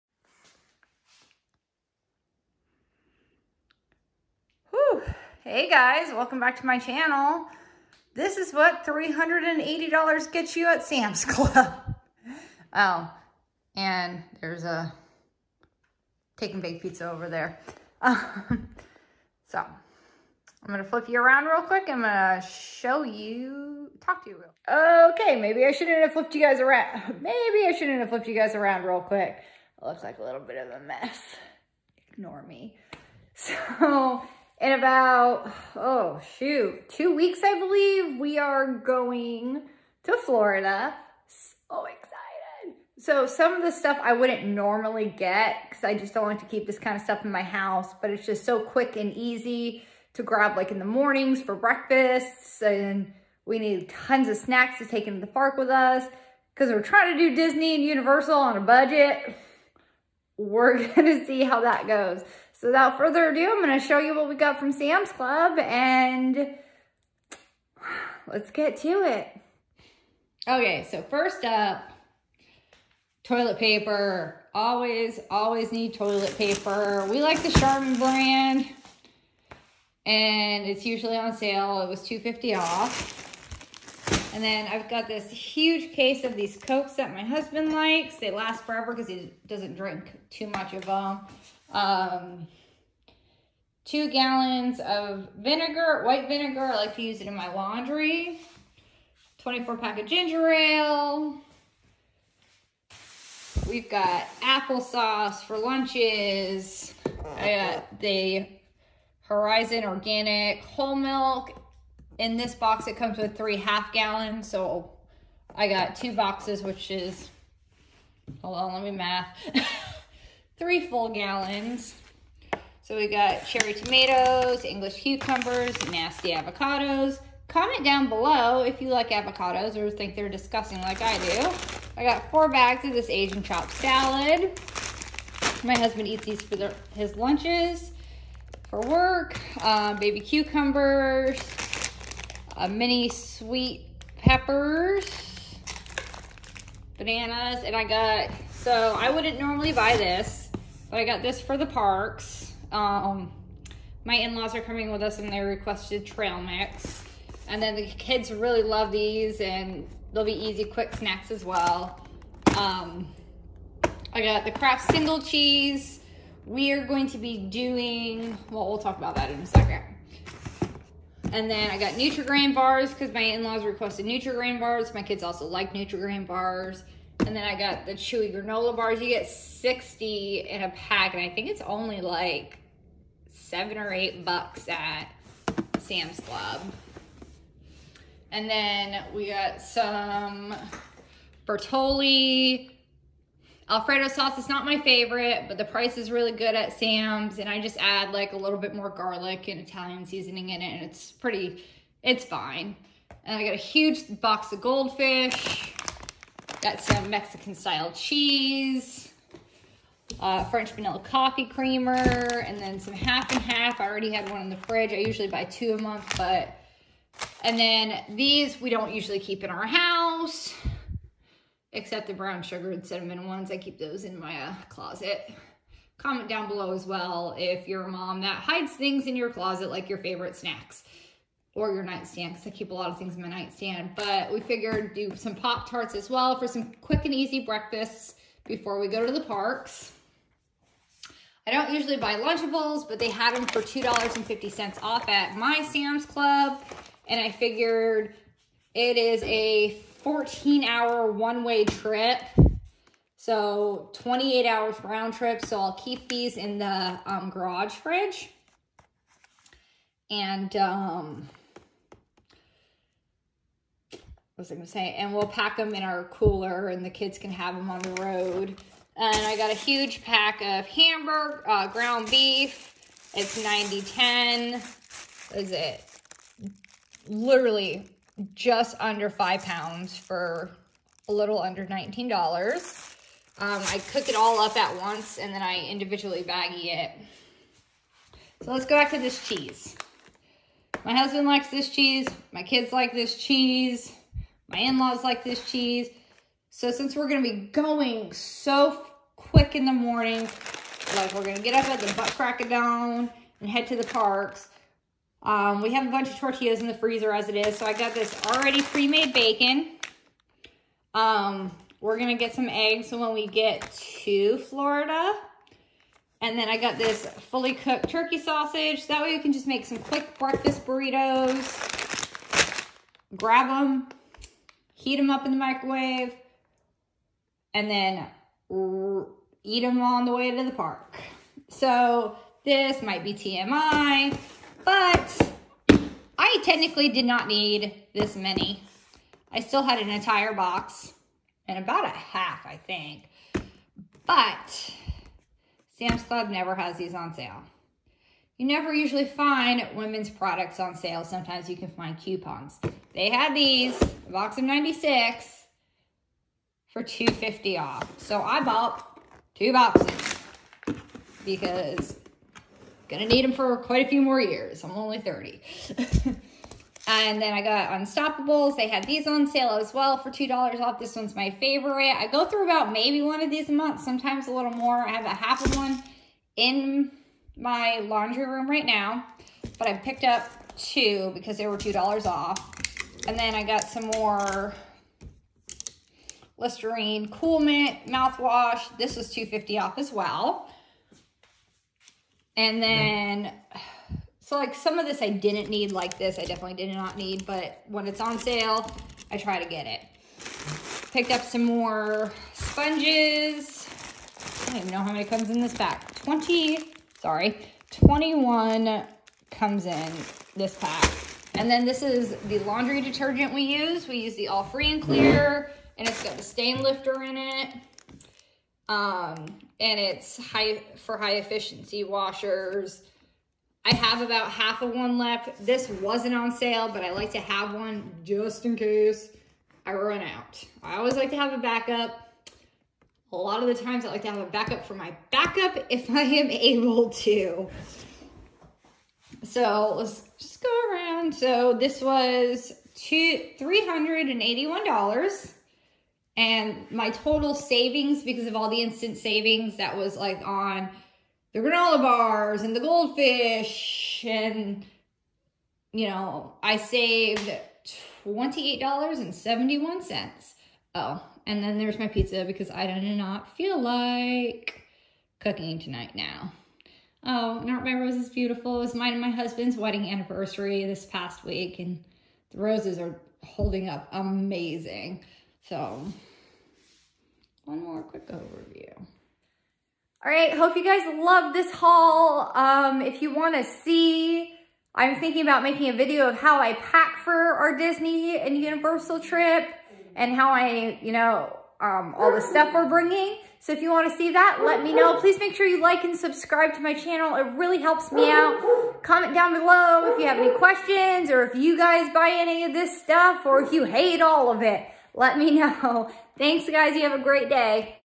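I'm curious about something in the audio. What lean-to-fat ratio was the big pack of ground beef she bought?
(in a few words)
90-10.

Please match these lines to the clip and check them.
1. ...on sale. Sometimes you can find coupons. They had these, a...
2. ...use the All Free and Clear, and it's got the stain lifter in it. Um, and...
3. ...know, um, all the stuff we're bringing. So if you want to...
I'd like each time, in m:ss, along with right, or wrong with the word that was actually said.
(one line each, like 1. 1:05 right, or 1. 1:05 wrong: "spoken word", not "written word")
1. 5:50 right
2. 6:53 right
3. 8:10 right.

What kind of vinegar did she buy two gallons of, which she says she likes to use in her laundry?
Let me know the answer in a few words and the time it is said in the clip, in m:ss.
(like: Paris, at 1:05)
white vinegar, at 1:36.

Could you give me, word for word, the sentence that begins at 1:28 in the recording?
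They last forever because he doesn't drink too much of them.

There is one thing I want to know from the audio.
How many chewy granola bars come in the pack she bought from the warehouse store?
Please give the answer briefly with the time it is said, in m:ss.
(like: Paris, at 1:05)
60, at 2:59.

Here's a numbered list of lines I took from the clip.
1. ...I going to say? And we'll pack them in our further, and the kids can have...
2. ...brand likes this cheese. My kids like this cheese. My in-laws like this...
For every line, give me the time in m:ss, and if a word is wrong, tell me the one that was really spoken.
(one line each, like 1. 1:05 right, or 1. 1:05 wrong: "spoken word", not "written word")
1. 4:24 wrong: "cooler", not "further"
2. 4:50 wrong: "husband", not "brand".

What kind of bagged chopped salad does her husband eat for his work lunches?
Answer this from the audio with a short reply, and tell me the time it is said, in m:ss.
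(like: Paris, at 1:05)
Asian chopped salad, at 2:13.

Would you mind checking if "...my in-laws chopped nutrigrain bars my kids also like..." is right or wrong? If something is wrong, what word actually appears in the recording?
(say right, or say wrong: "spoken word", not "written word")
wrong: "requested", not "chopped".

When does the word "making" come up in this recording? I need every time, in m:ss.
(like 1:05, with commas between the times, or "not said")
8:05.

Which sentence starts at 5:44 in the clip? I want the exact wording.
But Sam's Club never has these on sale.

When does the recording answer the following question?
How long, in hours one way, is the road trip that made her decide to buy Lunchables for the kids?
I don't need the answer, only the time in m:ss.
4:10.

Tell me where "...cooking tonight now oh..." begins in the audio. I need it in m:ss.
7:45.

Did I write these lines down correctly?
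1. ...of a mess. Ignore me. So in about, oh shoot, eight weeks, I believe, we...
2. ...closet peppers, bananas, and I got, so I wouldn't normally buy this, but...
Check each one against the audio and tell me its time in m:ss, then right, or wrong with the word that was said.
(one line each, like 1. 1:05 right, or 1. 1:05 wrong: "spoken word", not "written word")
1. 0:30 wrong: "two", not "eight"
2. 2:23 wrong: "sweet", not "closet".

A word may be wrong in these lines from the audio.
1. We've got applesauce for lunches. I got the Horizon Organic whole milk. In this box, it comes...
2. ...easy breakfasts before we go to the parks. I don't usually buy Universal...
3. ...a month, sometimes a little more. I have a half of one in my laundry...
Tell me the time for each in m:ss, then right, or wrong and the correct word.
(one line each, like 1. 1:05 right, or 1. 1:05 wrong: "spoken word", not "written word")
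1. 1:43 right
2. 3:57 wrong: "Lunchables", not "Universal"
3. 6:13 right.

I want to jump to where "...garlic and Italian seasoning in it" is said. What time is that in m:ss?
3:18.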